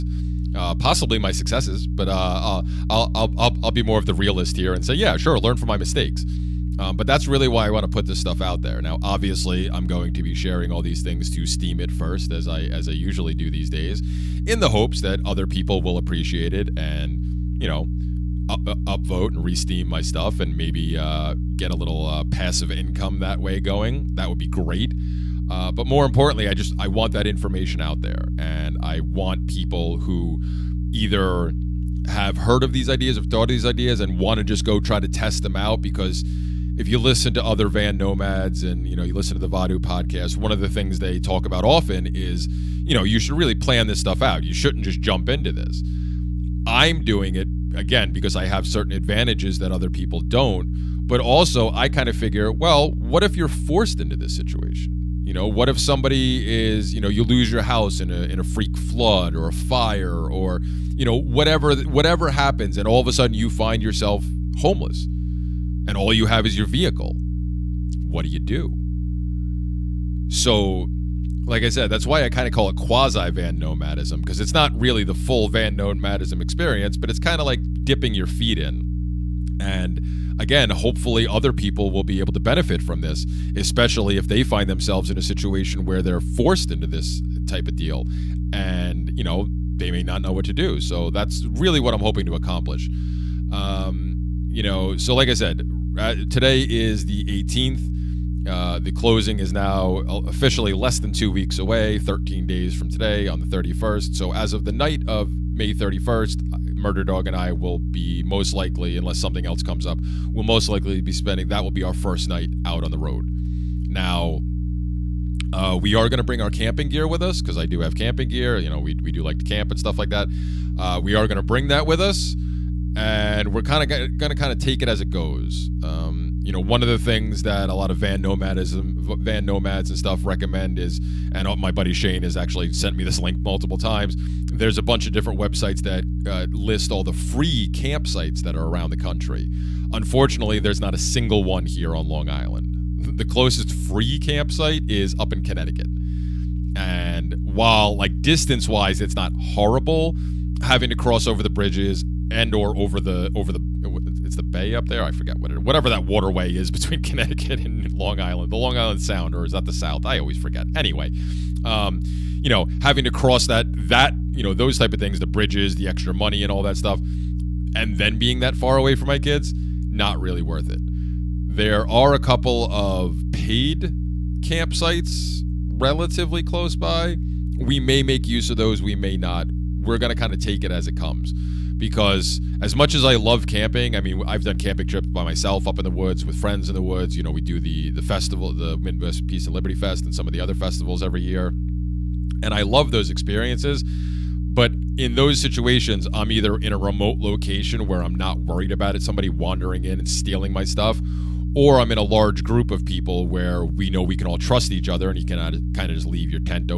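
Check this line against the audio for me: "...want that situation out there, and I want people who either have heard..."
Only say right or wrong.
wrong.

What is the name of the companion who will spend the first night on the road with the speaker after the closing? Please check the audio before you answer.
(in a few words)
Murder Dog.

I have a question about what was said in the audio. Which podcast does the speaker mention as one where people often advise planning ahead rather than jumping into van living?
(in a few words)
Vonu podcast.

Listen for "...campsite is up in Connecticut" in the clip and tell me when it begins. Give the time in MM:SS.
02:24.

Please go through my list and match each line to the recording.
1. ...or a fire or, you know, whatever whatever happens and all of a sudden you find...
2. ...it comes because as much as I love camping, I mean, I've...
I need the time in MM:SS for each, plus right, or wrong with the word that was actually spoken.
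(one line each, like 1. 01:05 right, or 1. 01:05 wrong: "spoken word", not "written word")
1. 00:59 right
2. 03:00 right.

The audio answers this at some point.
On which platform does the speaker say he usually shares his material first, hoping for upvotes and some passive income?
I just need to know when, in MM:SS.
00:11.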